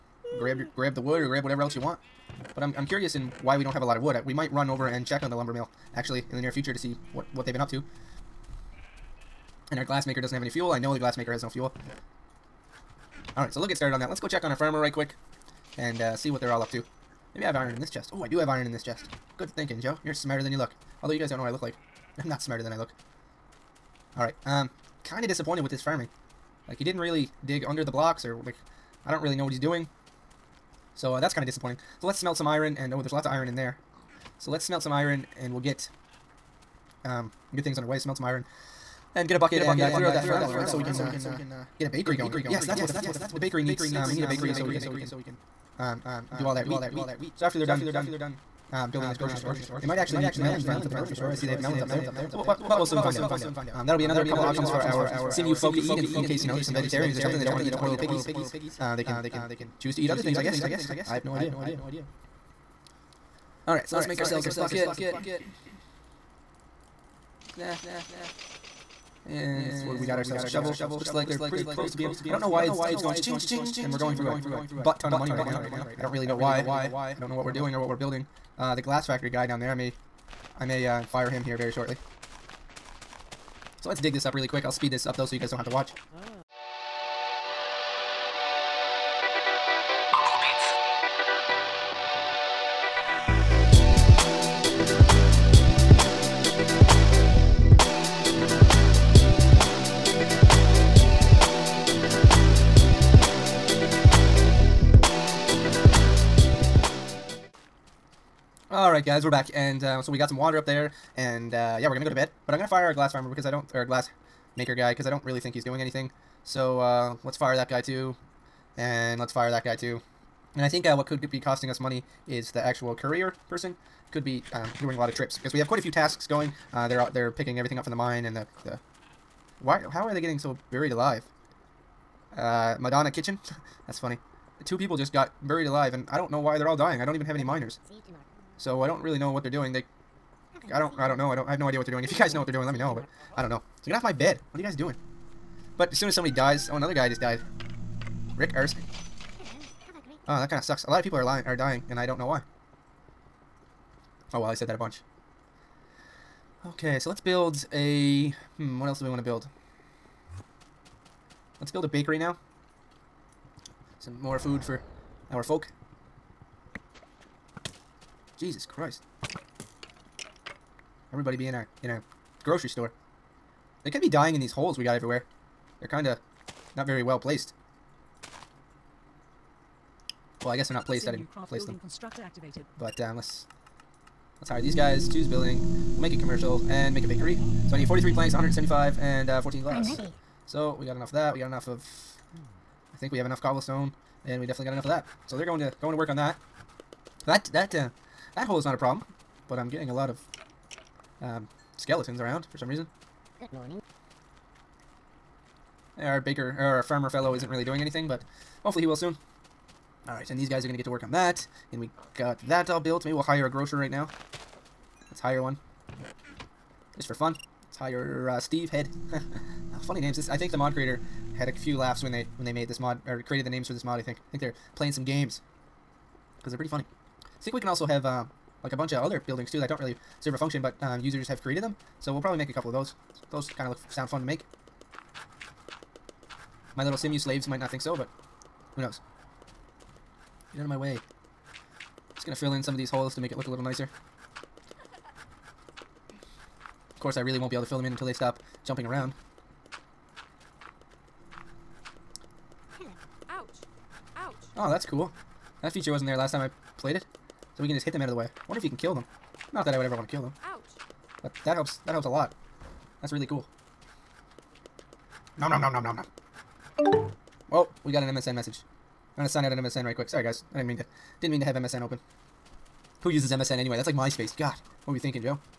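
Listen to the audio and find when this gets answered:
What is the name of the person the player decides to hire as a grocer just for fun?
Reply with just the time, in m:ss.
3:38.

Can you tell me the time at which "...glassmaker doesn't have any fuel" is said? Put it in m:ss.
0:09.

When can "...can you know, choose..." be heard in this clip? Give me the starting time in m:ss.
0:59.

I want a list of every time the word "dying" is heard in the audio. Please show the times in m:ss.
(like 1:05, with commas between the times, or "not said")
2:16, 2:31, 2:54.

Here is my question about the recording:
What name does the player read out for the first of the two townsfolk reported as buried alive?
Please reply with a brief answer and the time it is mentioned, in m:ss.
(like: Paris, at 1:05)
Madonna Kitchen, at 2:12.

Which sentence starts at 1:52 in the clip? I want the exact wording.
But I'm gonna fire our glass farmer because I don't, or glass maker guy, because I don't really think he's doing anything.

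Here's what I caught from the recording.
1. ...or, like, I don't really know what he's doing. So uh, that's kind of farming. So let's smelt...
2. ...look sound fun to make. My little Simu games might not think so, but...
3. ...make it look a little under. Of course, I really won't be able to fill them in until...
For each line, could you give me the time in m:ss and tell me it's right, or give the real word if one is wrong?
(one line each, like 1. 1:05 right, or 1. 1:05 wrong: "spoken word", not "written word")
1. 0:28 wrong: "disappointing", not "farming"
2. 3:53 wrong: "slaves", not "games"
3. 4:03 wrong: "nicer", not "under".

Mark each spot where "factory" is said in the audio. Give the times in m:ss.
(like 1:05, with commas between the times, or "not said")
1:19.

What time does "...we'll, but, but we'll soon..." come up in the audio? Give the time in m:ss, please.
0:52.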